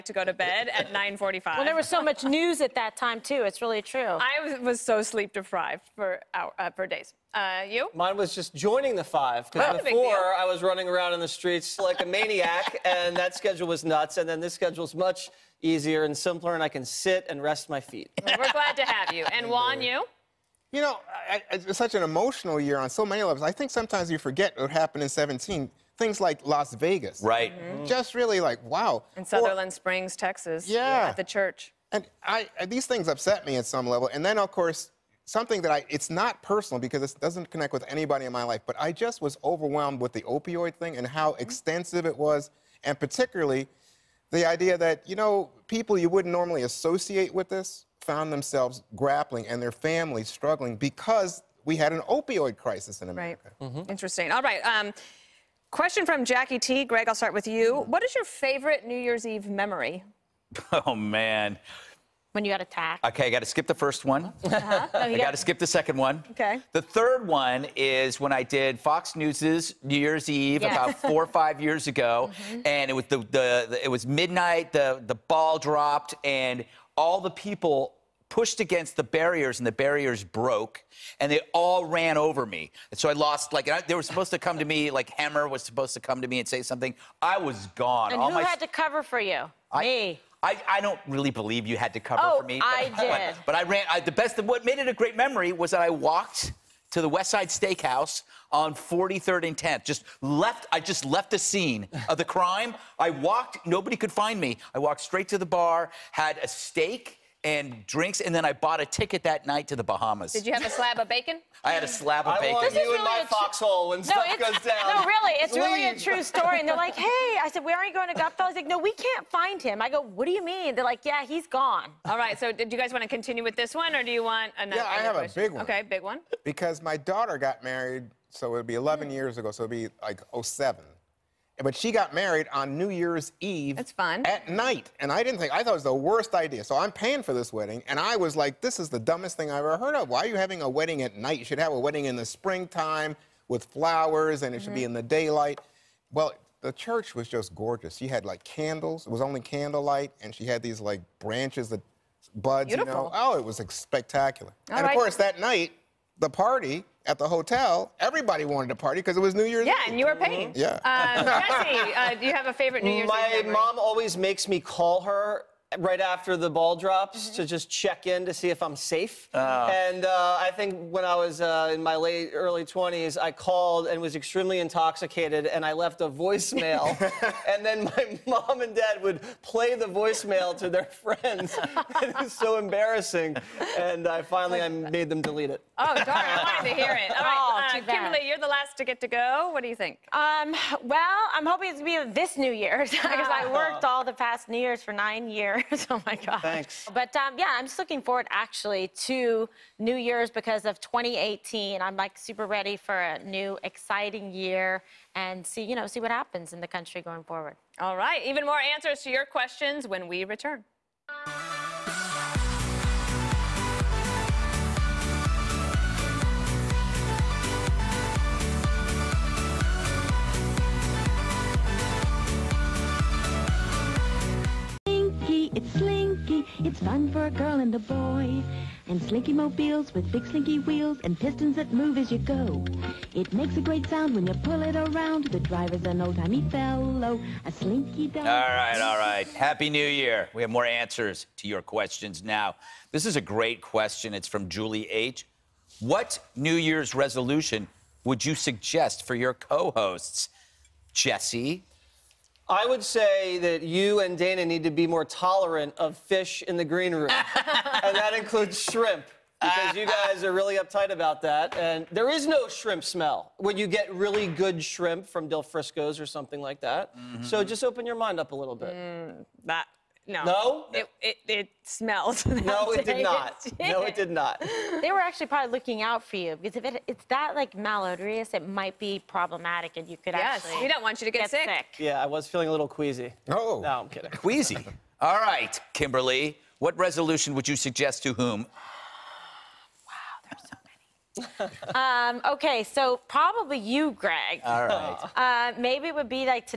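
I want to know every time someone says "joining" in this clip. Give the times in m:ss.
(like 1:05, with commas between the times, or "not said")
0:08.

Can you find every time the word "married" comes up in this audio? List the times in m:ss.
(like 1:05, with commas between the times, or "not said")
2:07, 2:12.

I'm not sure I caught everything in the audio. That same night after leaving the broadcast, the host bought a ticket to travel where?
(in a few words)
the Bahamas.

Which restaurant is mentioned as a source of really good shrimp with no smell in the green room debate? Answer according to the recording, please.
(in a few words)
Del Frisco's.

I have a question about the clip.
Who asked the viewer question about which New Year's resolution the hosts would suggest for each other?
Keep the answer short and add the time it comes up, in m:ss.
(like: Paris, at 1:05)
Julie H., at 4:04.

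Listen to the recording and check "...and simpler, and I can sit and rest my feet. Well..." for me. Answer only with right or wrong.
right.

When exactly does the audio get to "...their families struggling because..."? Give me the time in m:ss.
0:49.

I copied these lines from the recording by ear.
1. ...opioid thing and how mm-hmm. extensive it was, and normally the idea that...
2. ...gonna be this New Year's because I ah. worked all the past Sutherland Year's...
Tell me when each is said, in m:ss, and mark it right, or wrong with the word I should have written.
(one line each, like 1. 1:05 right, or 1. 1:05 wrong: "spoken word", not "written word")
1. 0:40 wrong: "particularly", not "normally"
2. 3:11 wrong: "New", not "Sutherland".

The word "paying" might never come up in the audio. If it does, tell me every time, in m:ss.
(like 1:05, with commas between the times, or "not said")
2:16, 2:40.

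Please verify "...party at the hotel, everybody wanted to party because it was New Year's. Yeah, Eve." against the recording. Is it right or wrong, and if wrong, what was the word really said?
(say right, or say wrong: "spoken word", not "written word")
right.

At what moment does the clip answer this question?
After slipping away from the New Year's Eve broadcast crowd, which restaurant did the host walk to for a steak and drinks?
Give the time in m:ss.
1:37.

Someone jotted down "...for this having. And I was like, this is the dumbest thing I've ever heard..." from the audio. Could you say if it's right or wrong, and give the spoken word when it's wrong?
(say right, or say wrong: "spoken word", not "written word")
wrong: "wedding", not "having".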